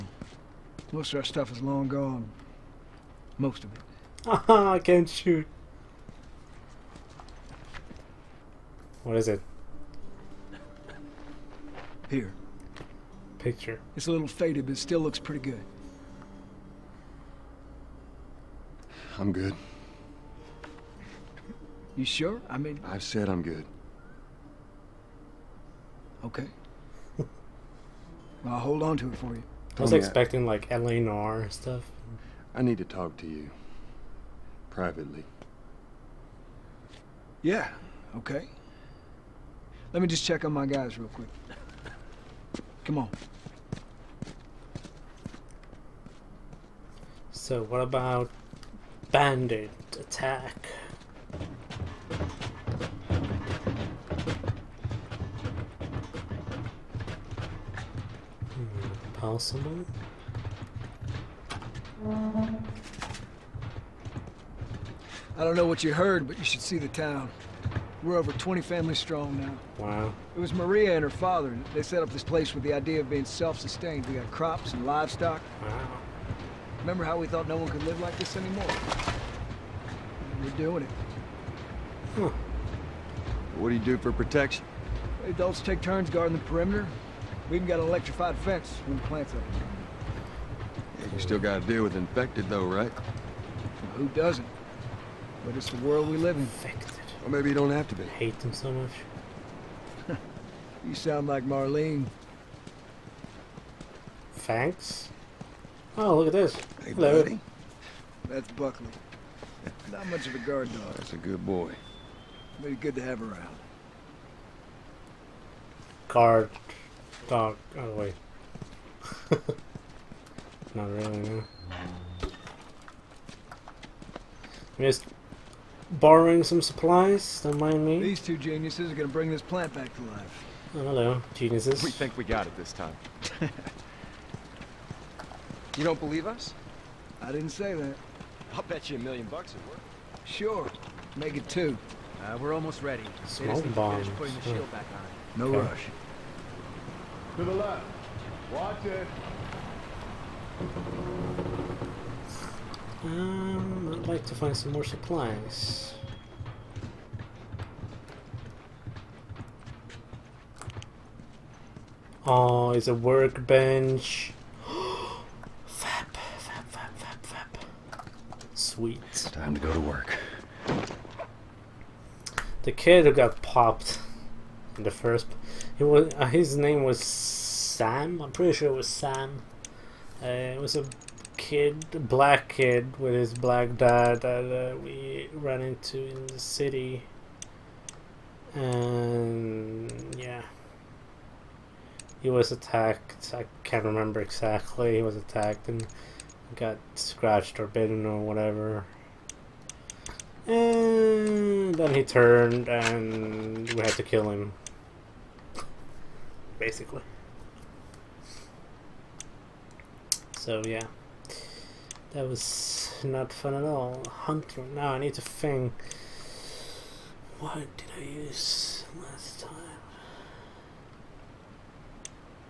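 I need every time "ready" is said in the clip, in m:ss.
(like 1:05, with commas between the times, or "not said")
2:22.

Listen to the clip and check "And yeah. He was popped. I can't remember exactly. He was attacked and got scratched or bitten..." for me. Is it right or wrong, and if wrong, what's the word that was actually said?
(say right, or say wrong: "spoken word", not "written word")
wrong: "attacked", not "popped".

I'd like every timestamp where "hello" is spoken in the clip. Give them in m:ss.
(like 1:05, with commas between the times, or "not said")
1:46, 2:10.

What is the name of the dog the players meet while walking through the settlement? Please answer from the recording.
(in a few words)
Buckley.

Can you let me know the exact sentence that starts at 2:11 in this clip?
We think we got it this time.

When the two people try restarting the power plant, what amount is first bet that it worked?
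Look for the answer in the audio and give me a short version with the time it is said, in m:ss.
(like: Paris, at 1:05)
a million bucks, at 2:18.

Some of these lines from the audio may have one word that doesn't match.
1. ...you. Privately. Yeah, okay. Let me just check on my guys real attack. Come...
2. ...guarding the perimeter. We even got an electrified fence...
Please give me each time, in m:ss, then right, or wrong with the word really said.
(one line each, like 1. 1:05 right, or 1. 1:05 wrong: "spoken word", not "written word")
1. 0:33 wrong: "quick", not "attack"
2. 1:26 right.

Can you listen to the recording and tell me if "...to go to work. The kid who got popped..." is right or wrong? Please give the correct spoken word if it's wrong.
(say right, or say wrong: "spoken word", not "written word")
right.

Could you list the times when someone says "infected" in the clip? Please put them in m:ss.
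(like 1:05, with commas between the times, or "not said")
1:31, 1:36.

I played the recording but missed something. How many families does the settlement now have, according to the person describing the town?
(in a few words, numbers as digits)
over 20.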